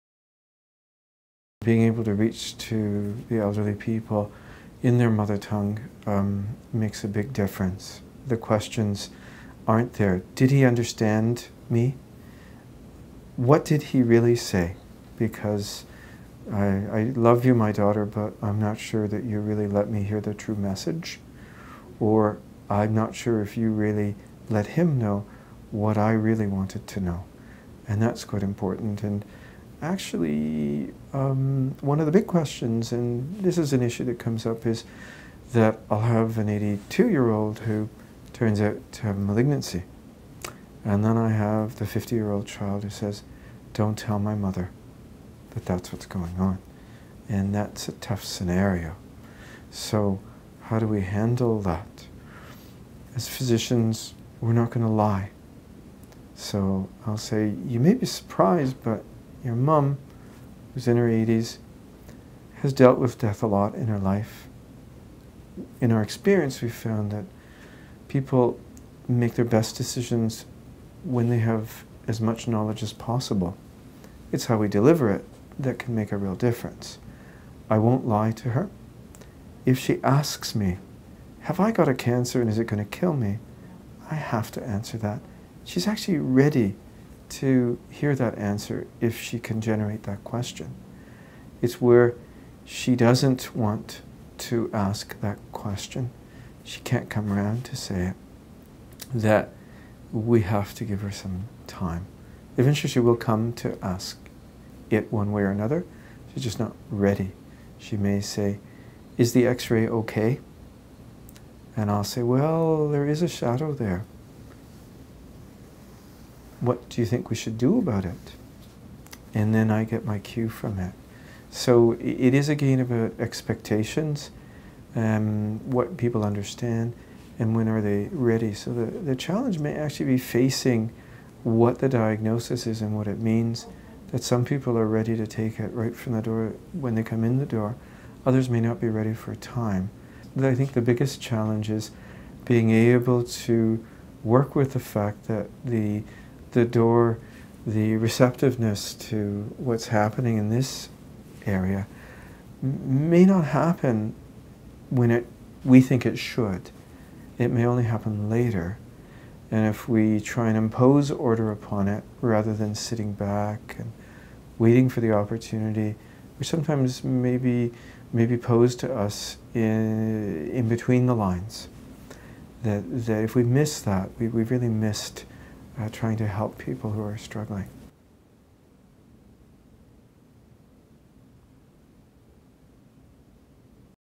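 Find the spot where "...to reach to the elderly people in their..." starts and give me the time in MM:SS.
00:02.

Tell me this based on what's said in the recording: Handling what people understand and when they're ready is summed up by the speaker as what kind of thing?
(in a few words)
game.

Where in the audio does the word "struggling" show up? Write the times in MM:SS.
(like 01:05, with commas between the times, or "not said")
02:57.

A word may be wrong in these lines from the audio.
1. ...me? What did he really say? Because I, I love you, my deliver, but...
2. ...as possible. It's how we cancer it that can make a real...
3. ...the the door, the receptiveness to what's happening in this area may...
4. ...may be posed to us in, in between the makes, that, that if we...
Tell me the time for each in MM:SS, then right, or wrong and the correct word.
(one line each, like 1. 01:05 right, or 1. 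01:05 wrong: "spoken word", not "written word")
1. 00:11 wrong: "daughter", not "deliver"
2. 01:12 wrong: "deliver", not "cancer"
3. 02:25 right
4. 02:48 wrong: "lines", not "makes".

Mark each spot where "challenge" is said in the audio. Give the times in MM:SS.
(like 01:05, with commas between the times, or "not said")
02:09, 02:21.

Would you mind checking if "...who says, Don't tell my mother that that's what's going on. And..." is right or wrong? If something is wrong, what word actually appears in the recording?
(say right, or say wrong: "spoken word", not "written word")
right.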